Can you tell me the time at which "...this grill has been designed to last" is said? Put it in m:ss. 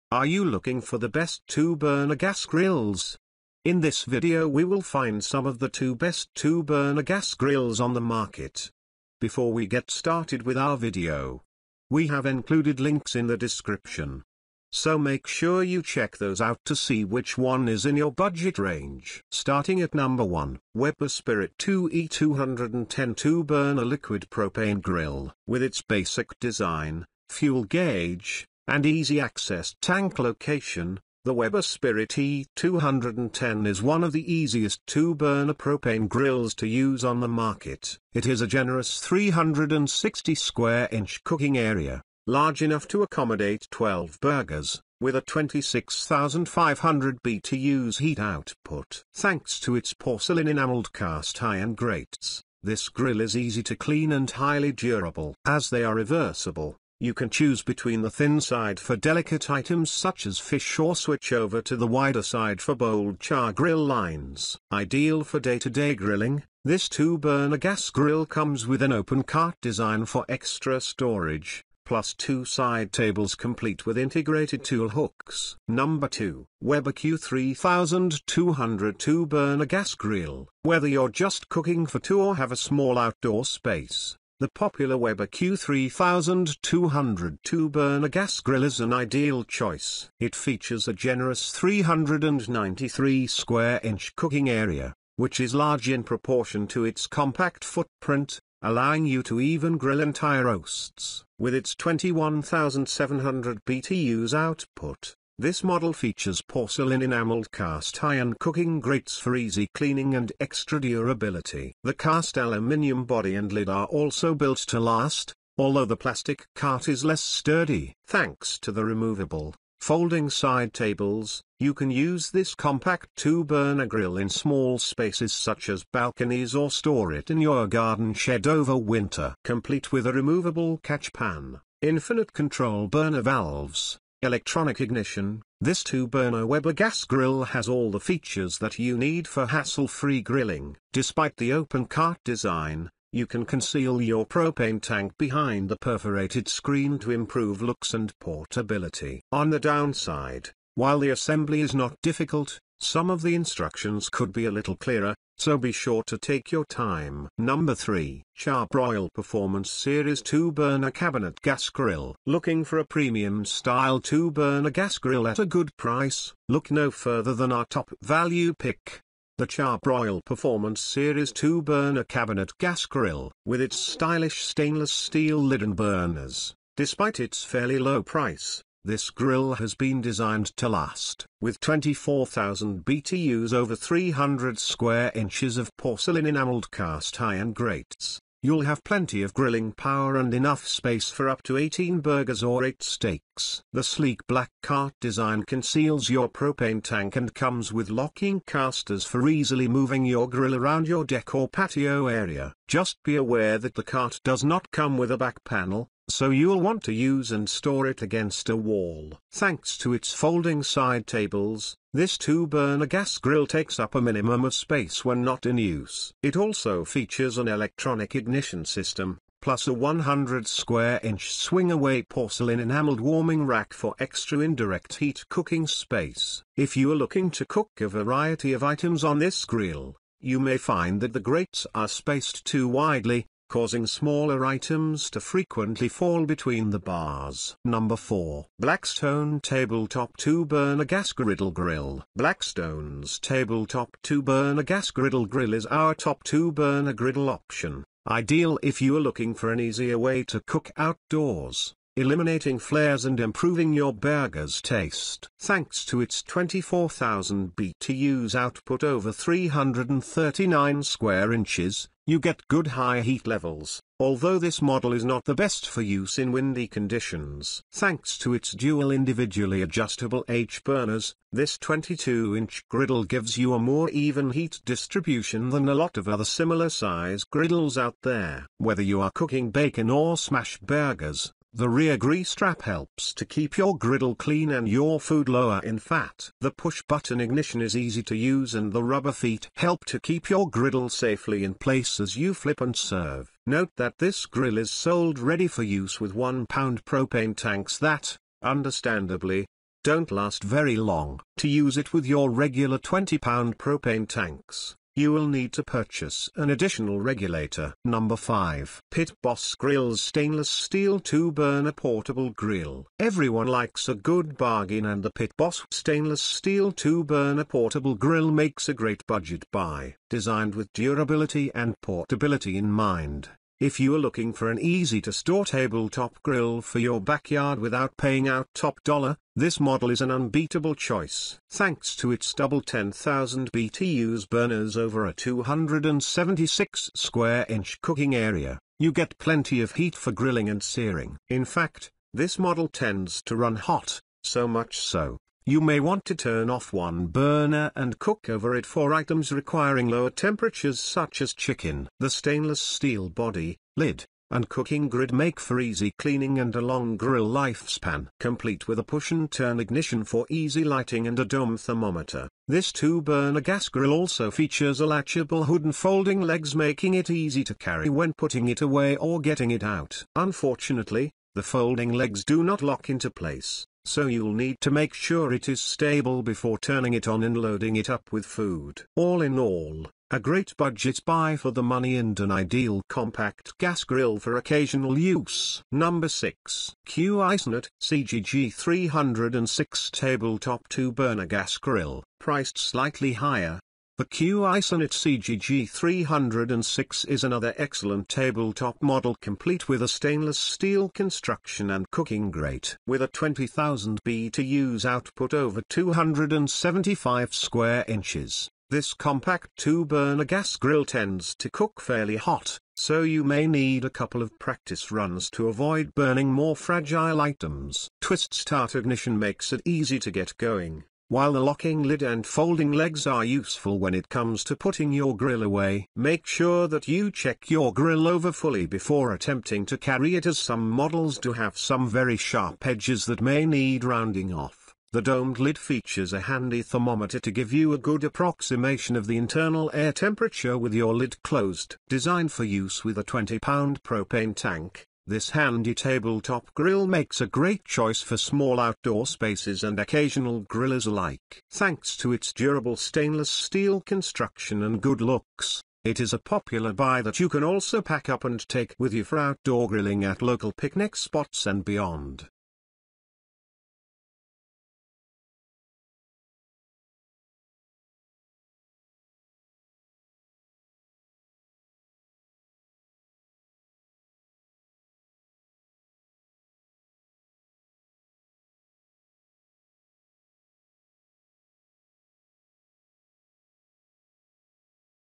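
2:58.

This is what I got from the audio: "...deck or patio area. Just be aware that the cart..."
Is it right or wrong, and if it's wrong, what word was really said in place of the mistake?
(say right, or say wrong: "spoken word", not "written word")
right.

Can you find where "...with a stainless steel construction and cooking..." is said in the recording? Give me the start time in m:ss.
6:39.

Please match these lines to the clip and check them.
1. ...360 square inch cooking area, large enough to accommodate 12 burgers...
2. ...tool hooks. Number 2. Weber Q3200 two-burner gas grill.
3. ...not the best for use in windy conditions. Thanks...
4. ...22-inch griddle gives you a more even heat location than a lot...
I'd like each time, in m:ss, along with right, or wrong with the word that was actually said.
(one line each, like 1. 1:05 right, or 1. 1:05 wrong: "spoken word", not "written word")
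1. 0:38 right
2. 1:14 right
3. 4:25 right
4. 4:31 wrong: "distribution", not "location".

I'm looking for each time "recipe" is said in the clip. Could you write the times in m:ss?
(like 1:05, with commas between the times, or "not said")
not said.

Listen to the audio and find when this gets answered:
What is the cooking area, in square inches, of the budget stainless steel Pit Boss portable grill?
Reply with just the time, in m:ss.
5:35.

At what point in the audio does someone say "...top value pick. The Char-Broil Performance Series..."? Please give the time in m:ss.
2:47.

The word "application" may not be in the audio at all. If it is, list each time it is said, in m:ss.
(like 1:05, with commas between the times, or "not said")
not said.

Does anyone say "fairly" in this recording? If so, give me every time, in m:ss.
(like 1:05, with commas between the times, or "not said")
2:57, 6:51.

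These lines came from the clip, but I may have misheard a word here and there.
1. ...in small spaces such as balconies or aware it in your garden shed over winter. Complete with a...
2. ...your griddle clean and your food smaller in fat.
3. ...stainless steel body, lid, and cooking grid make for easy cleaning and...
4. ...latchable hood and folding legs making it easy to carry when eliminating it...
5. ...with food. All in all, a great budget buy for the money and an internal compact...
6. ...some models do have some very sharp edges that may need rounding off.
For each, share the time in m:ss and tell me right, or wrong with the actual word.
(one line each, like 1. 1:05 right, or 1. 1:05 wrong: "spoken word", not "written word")
1. 2:04 wrong: "store", not "aware"
2. 4:43 wrong: "lower", not "smaller"
3. 5:52 right
4. 6:04 wrong: "putting", not "eliminating"
5. 6:18 wrong: "ideal", not "internal"
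6. 7:10 right.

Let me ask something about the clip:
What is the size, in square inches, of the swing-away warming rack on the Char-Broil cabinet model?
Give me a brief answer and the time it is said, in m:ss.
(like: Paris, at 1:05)
100, at 3:39.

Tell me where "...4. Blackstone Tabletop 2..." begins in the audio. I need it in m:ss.
3:57.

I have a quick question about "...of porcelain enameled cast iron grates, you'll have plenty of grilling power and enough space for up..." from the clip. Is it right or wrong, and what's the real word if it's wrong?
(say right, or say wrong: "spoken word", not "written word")
right.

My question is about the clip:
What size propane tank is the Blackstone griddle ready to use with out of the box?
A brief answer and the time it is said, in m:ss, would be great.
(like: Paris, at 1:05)
1 pound, at 4:56.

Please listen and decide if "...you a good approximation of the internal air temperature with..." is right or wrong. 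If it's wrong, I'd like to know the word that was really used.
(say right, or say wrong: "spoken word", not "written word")
right.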